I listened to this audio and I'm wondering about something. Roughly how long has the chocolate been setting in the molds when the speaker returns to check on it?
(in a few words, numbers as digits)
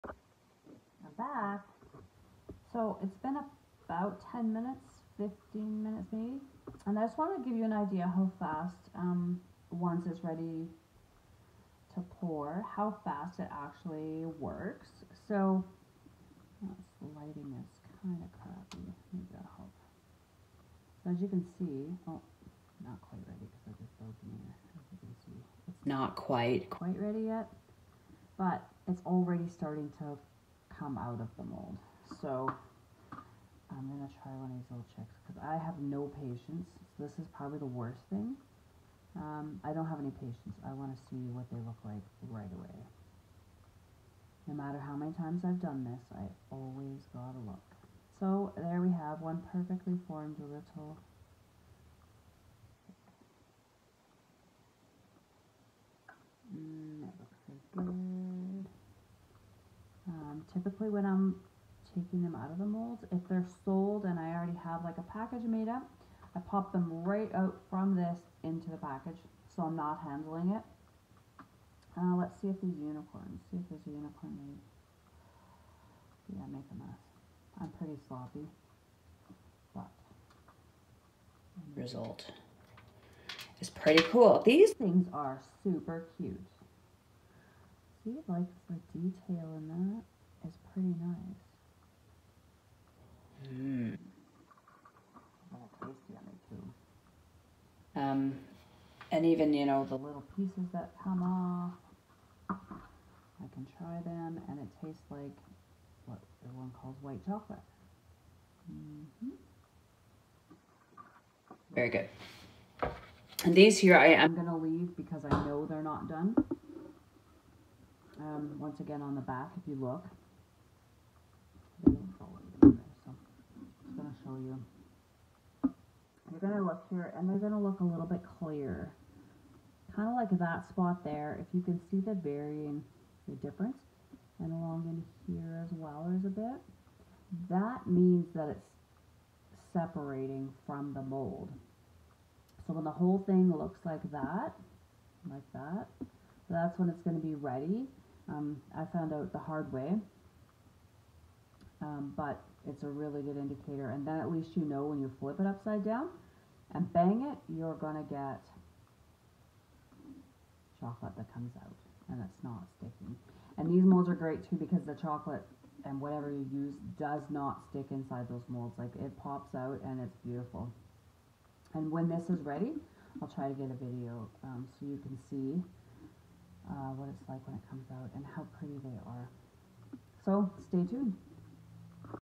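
10 to 15 minutes.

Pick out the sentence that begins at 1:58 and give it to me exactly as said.
Um, once again on the back, if you look, you.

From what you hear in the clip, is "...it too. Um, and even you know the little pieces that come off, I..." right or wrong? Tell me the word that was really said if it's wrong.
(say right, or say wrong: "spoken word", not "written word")
right.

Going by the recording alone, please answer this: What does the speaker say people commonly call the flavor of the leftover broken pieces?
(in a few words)
white chocolate.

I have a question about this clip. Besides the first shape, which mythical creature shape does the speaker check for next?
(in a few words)
unicorns.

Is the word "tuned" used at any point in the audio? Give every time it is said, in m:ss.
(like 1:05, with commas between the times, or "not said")
3:00.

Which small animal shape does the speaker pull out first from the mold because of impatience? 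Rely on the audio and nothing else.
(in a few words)
chicks.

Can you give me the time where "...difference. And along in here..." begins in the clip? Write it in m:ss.
2:13.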